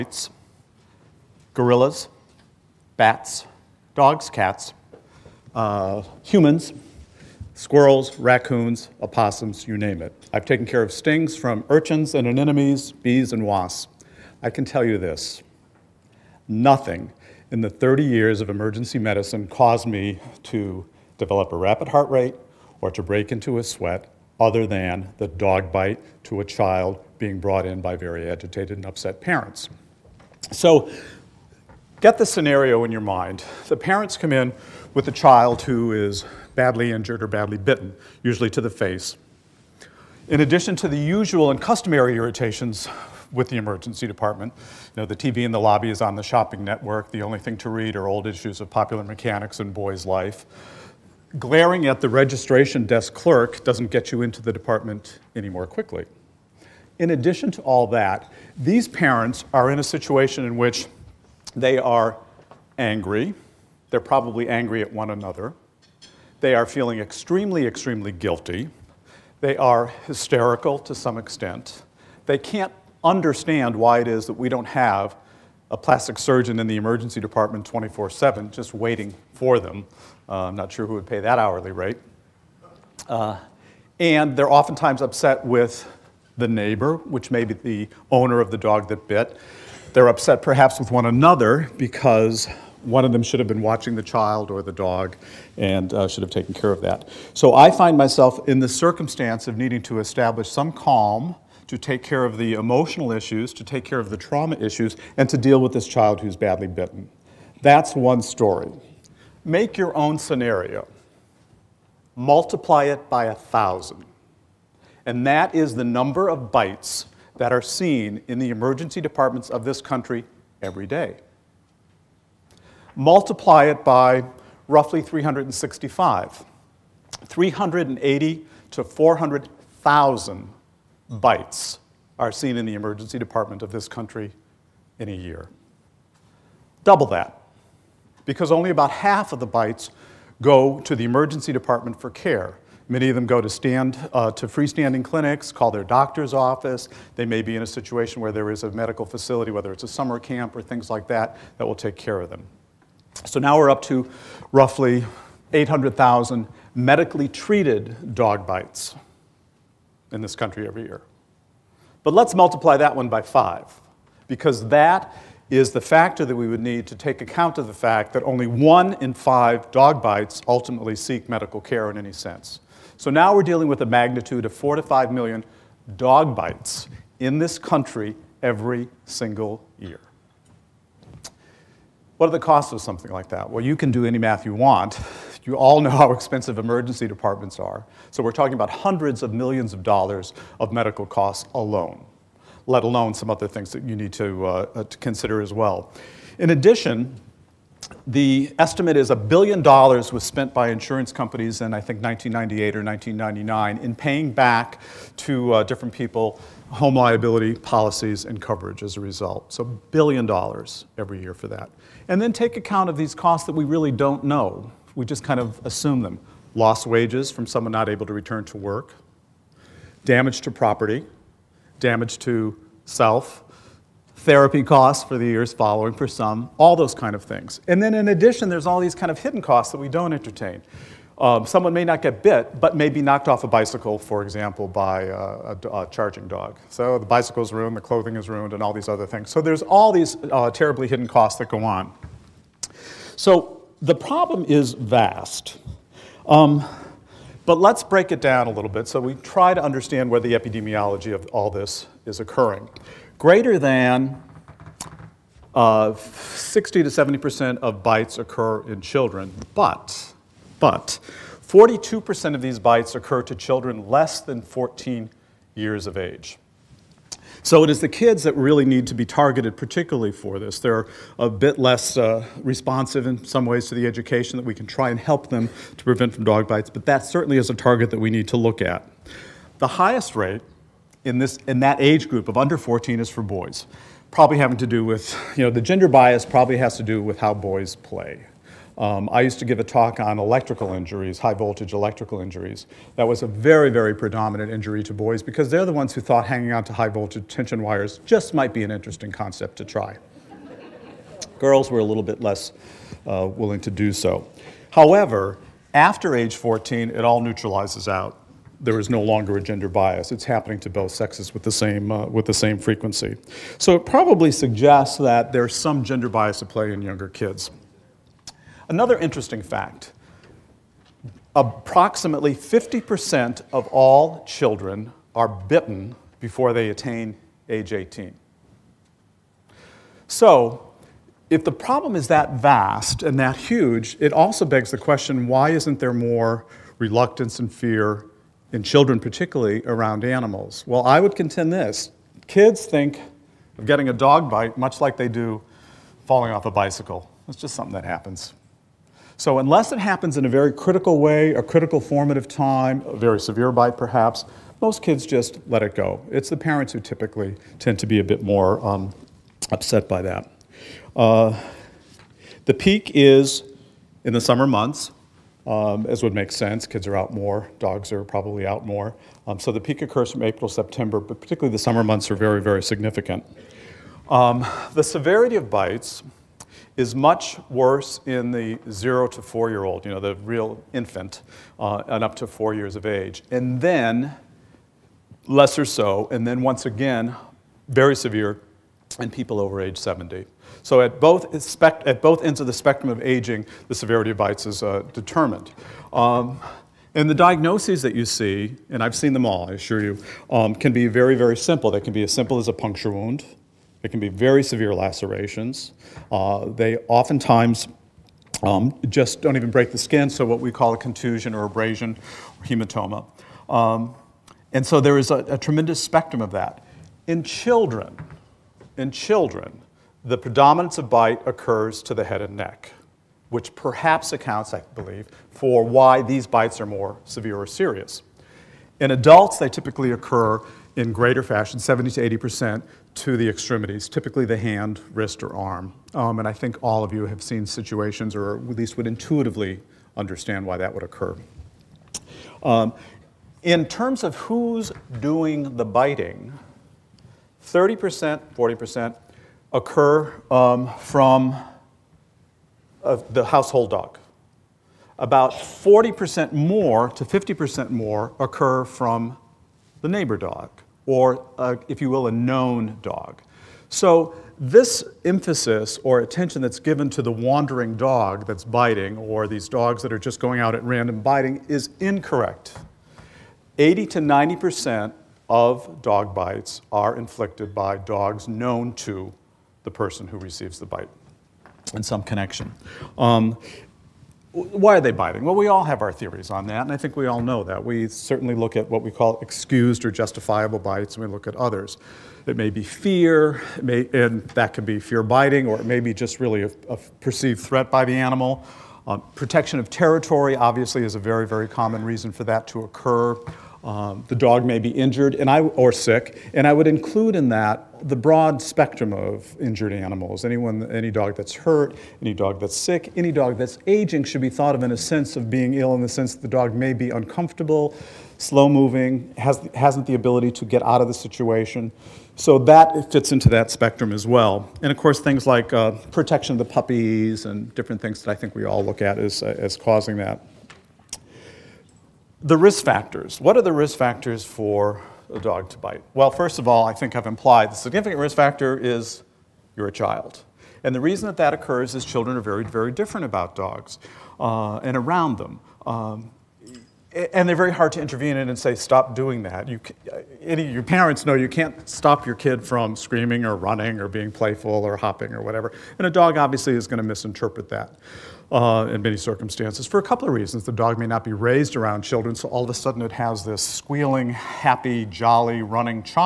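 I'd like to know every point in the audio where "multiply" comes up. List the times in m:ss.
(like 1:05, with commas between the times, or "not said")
1:52, 2:02, 2:42.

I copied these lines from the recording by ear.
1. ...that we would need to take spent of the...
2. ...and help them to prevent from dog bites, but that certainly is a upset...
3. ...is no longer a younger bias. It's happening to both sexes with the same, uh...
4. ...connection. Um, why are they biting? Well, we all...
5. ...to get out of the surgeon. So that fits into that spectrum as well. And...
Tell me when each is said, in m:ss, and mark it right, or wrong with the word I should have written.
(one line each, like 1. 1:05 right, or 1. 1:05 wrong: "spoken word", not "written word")
1. 2:46 wrong: "account", not "spent"
2. 4:34 wrong: "target", not "upset"
3. 5:08 wrong: "gender", not "younger"
4. 8:02 right
5. 8:40 wrong: "situation", not "surgeon".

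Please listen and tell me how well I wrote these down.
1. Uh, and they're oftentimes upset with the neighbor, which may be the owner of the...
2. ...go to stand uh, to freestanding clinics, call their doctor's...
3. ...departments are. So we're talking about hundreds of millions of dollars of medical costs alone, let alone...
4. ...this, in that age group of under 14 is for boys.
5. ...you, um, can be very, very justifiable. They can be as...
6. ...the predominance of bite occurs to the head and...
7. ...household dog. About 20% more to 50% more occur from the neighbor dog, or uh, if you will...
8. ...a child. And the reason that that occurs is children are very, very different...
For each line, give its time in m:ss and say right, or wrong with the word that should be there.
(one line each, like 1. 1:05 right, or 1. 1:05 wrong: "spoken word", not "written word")
1. 1:23 right
2. 2:23 right
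3. 3:07 right
4. 4:41 right
5. 6:39 wrong: "simple", not "justifiable"
6. 7:00 right
7. 7:33 wrong: "40", not "20"
8. 8:59 right.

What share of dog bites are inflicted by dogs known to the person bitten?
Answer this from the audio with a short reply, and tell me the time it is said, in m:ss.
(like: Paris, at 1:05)
80 to 90%, at 7:53.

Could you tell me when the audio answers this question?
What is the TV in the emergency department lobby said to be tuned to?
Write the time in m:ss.
0:46.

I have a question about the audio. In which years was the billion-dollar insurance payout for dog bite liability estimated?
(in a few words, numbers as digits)
1998 or 1999.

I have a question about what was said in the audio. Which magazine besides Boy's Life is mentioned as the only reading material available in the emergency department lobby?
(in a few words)
Popular Mechanics.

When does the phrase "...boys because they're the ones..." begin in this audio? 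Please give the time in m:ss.
4:54.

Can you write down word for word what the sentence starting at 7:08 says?
In adults, they typically occur in greater fashion, 70 to 80 percent, to the extremities, typically the hand, wrist, or arm.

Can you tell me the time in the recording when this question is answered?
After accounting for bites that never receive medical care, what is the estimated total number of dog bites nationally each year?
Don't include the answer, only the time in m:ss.
2:54.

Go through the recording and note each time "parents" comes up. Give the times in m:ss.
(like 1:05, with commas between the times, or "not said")
0:29, 0:33, 0:58, 5:56, 9:10.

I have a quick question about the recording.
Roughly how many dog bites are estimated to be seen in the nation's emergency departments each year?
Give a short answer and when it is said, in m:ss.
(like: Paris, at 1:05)
380,000 to 400,000, at 2:07.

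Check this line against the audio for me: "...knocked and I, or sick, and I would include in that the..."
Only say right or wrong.
wrong.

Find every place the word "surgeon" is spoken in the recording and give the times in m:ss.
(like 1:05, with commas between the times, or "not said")
1:16.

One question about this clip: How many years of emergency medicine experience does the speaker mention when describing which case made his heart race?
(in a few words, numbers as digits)
30 years.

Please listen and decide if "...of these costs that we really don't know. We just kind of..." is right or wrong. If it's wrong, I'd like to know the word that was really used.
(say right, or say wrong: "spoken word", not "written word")
right.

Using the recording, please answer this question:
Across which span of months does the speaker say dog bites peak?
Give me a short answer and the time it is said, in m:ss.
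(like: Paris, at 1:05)
April to September, at 6:10.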